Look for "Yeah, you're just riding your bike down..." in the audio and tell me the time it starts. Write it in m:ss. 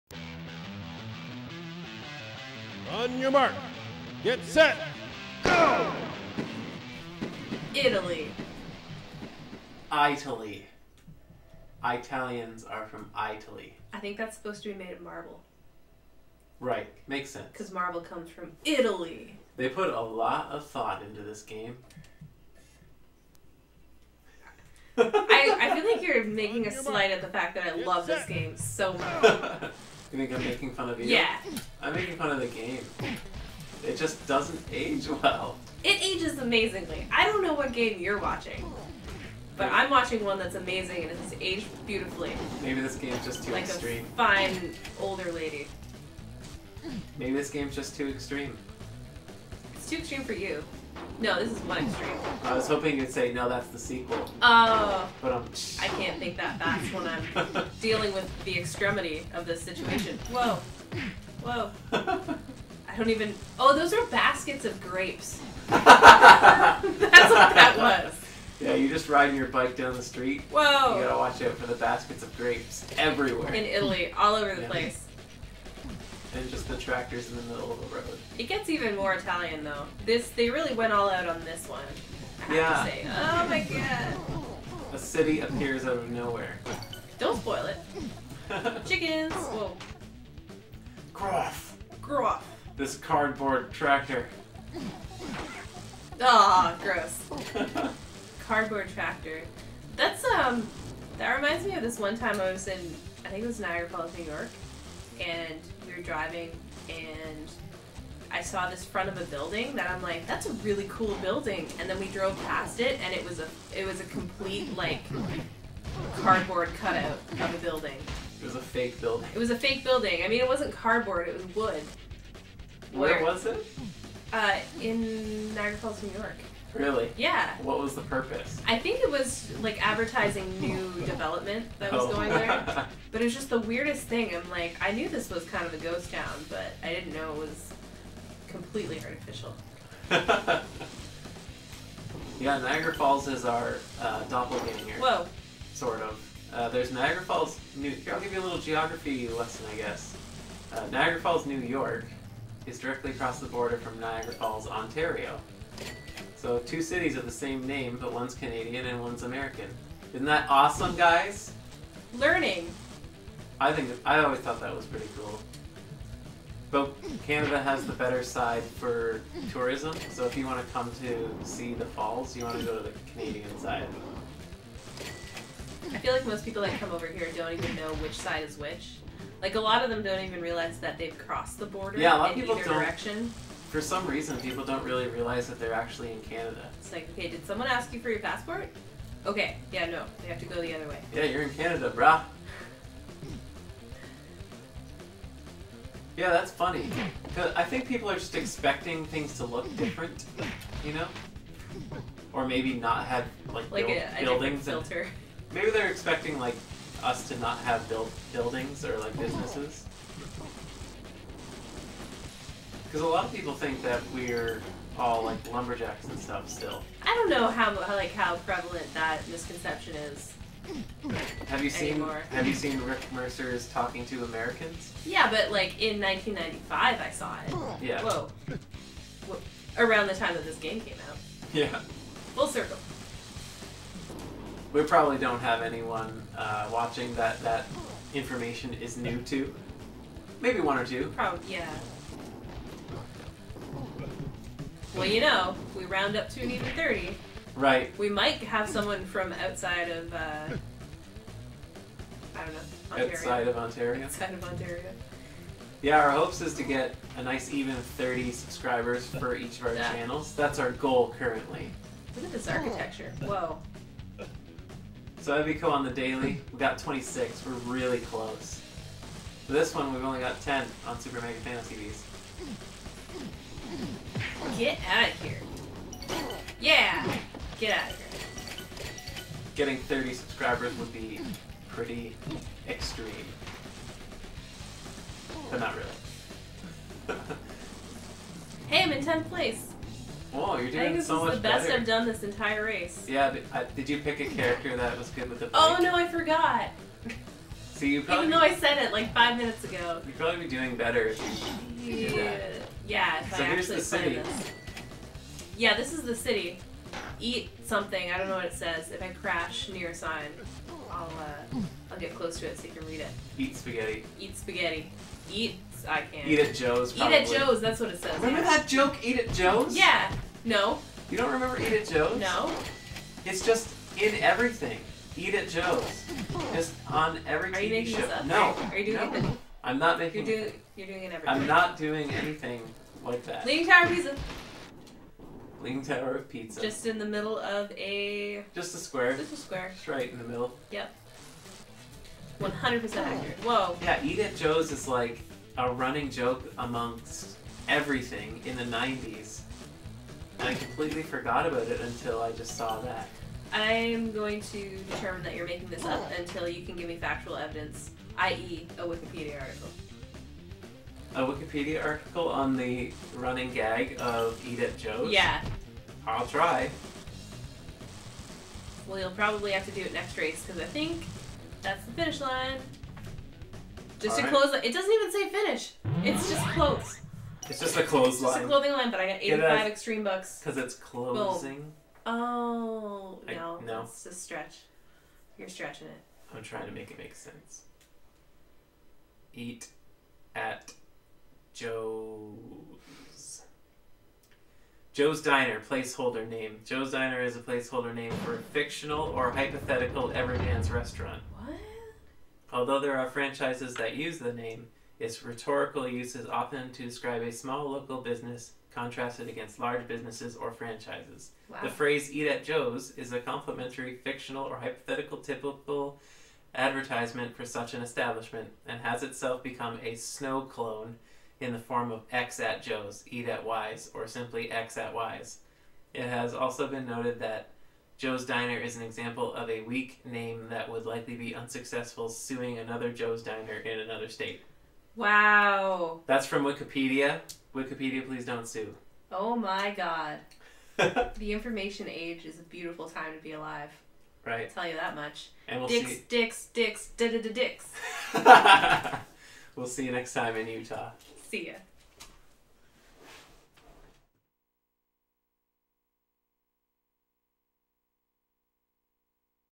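1:08.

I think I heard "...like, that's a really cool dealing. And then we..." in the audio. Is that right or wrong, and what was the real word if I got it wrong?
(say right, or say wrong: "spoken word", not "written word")
wrong: "building", not "dealing".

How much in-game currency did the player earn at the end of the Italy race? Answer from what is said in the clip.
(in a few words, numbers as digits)
85 extreme bucks.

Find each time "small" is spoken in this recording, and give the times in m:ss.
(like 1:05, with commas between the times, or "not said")
6:47.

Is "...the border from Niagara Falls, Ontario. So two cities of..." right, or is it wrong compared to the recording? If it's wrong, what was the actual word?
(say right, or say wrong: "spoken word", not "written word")
right.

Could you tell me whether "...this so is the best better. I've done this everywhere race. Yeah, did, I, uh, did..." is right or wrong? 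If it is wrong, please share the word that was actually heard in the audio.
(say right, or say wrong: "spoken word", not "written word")
wrong: "entire", not "everywhere".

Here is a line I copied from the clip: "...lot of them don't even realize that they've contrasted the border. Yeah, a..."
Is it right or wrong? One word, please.
wrong.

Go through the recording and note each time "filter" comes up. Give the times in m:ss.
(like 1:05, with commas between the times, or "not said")
3:24.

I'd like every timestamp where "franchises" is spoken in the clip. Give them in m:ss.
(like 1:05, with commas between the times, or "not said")
6:43, 6:50.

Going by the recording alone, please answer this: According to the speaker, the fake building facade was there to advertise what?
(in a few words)
new development.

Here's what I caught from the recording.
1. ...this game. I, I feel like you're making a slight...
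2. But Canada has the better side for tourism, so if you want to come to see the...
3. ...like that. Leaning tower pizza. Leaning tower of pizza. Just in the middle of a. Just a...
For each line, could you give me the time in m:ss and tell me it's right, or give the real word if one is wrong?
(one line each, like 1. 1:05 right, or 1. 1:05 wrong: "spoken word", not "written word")
1. 0:21 right
2. 2:46 right
3. 5:33 right.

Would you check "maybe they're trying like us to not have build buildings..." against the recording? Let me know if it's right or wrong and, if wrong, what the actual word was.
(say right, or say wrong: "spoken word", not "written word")
wrong: "expecting", not "trying".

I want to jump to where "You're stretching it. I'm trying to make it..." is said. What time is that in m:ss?
6:25.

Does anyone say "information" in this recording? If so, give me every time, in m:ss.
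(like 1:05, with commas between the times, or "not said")
3:58, 7:21.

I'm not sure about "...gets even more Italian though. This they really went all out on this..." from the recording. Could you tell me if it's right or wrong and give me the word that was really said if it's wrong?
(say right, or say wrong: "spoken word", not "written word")
right.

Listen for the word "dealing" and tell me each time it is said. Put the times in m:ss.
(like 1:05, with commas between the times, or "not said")
0:57.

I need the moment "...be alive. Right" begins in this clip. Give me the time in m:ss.
7:23.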